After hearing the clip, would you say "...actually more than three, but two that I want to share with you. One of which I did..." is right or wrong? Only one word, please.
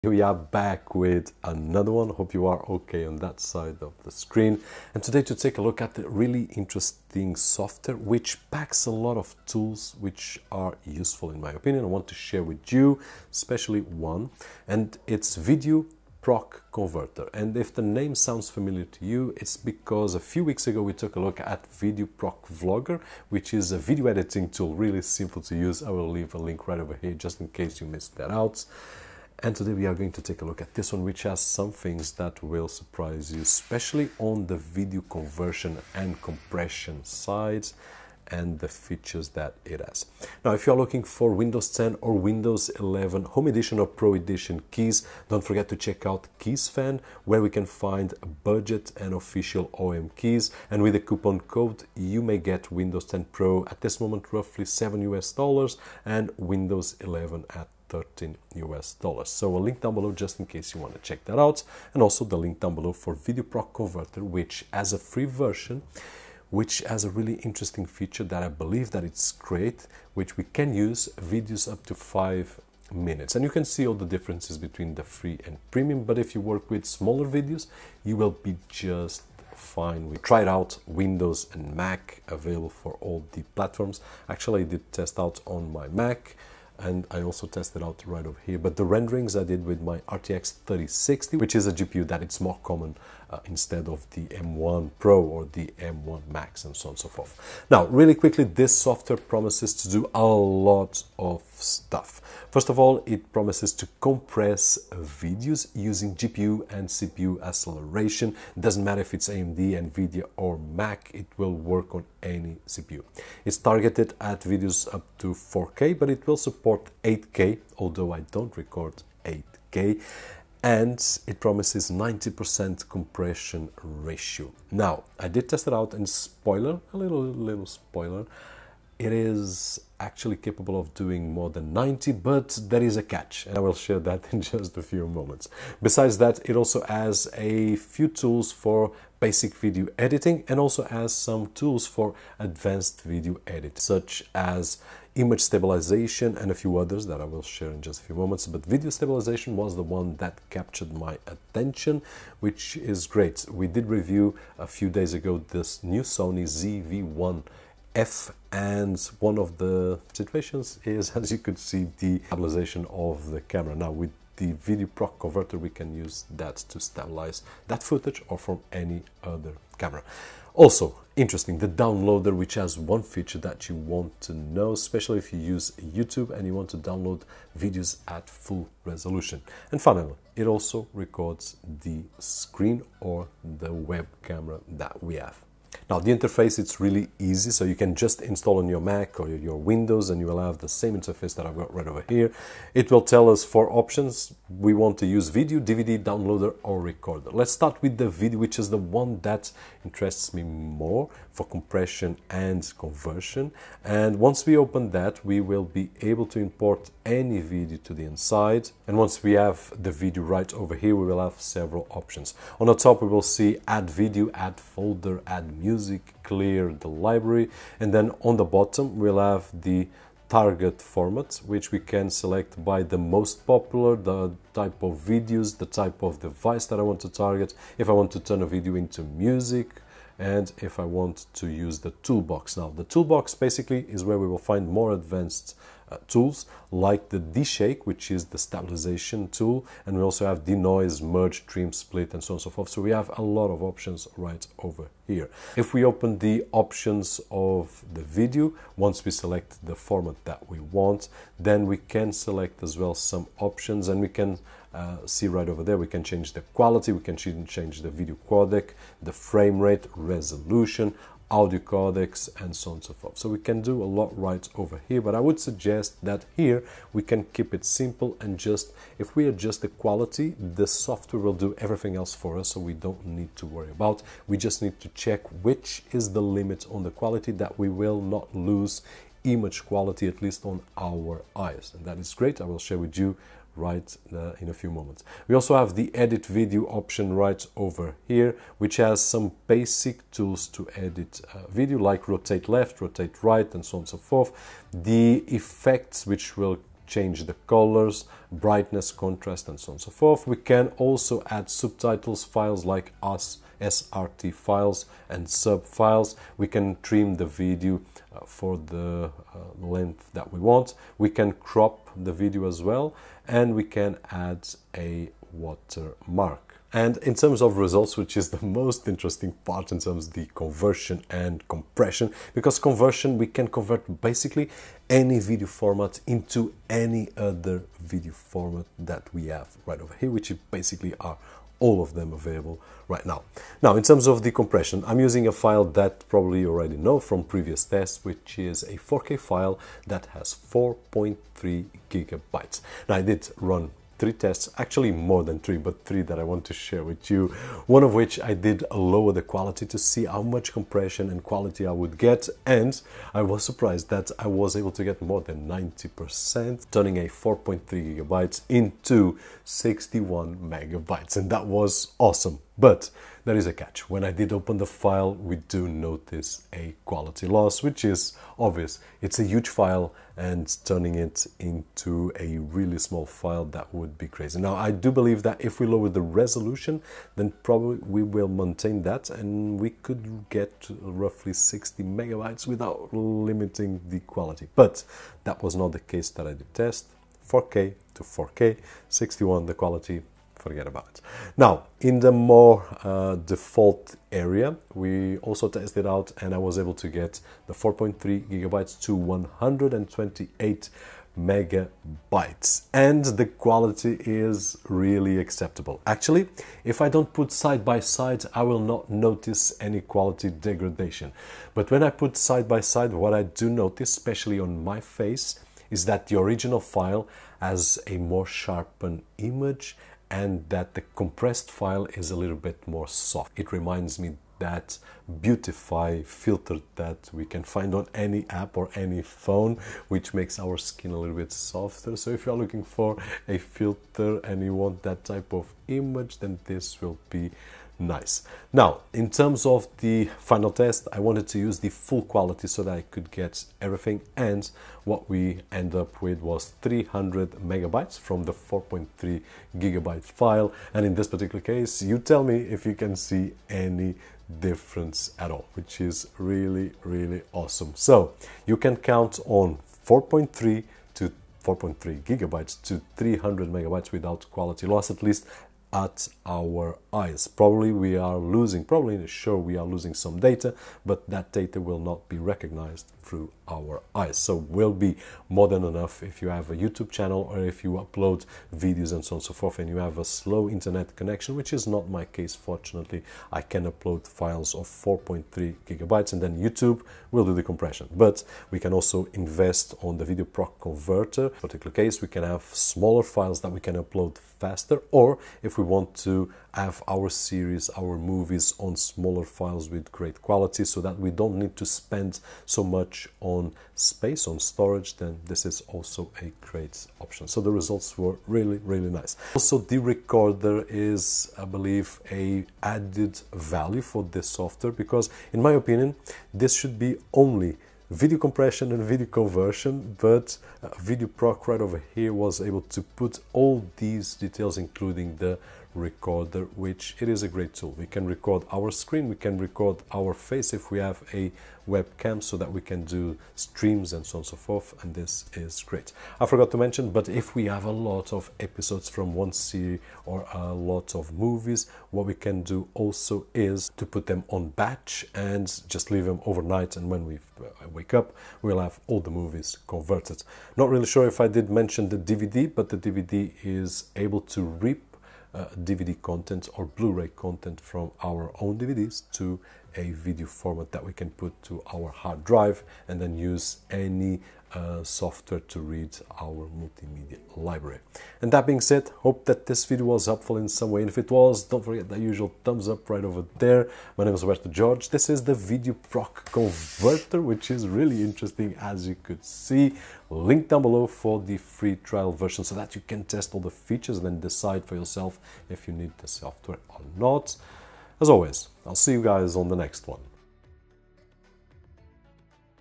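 wrong.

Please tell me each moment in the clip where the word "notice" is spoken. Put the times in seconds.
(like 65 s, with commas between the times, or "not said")
365 s, 408 s, 413 s.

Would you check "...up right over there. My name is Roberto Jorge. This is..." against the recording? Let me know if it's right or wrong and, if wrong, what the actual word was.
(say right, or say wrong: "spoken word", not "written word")
right.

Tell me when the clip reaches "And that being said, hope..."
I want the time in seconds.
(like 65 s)
568 s.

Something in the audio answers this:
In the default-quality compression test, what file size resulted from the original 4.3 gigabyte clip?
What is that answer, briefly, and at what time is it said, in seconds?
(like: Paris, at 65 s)
128 megabytes, at 398 s.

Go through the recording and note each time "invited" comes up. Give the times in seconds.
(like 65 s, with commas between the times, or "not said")
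not said.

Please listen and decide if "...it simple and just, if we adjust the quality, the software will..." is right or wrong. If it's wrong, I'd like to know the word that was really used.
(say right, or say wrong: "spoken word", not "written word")
right.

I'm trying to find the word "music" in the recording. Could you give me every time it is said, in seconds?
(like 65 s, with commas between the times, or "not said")
215 s, 229 s.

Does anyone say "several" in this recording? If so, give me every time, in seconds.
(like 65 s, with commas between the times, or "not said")
211 s.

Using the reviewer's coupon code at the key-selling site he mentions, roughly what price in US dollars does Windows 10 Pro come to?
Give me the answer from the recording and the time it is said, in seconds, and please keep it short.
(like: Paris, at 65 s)
7 US dollars, at 54 s.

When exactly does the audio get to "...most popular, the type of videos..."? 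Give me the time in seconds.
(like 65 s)
222 s.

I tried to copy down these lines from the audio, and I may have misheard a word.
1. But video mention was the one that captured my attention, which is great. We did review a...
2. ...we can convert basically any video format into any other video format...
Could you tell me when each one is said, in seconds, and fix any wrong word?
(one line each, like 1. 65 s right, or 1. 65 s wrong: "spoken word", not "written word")
1. 148 s wrong: "stabilization", not "mention"
2. 323 s right.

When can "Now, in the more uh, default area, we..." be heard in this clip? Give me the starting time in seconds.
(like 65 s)
391 s.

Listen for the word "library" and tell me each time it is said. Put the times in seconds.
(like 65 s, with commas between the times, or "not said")
216 s, 567 s.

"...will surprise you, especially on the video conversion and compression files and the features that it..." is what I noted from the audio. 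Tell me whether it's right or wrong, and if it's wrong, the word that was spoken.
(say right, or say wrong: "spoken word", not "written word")
wrong: "sides", not "files".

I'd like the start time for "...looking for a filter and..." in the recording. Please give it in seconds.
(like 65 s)
432 s.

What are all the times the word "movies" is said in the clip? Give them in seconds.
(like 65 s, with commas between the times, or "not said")
497 s, 541 s, 549 s.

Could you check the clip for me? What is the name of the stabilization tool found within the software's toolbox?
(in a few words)
D-Shake.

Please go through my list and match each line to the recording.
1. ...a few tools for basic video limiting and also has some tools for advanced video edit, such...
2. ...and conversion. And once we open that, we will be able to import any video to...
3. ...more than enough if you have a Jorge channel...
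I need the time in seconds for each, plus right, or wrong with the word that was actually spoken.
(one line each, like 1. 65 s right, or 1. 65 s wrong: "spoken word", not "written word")
1. 137 s wrong: "editing", not "limiting"
2. 202 s right
3. 475 s wrong: "YouTube", not "Jorge".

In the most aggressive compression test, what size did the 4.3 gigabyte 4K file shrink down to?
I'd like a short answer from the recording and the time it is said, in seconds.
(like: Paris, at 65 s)
61 megabytes, at 359 s.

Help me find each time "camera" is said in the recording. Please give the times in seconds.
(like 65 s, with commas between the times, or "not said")
163 s, 169 s, 184 s.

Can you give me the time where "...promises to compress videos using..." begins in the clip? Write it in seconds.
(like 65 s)
103 s.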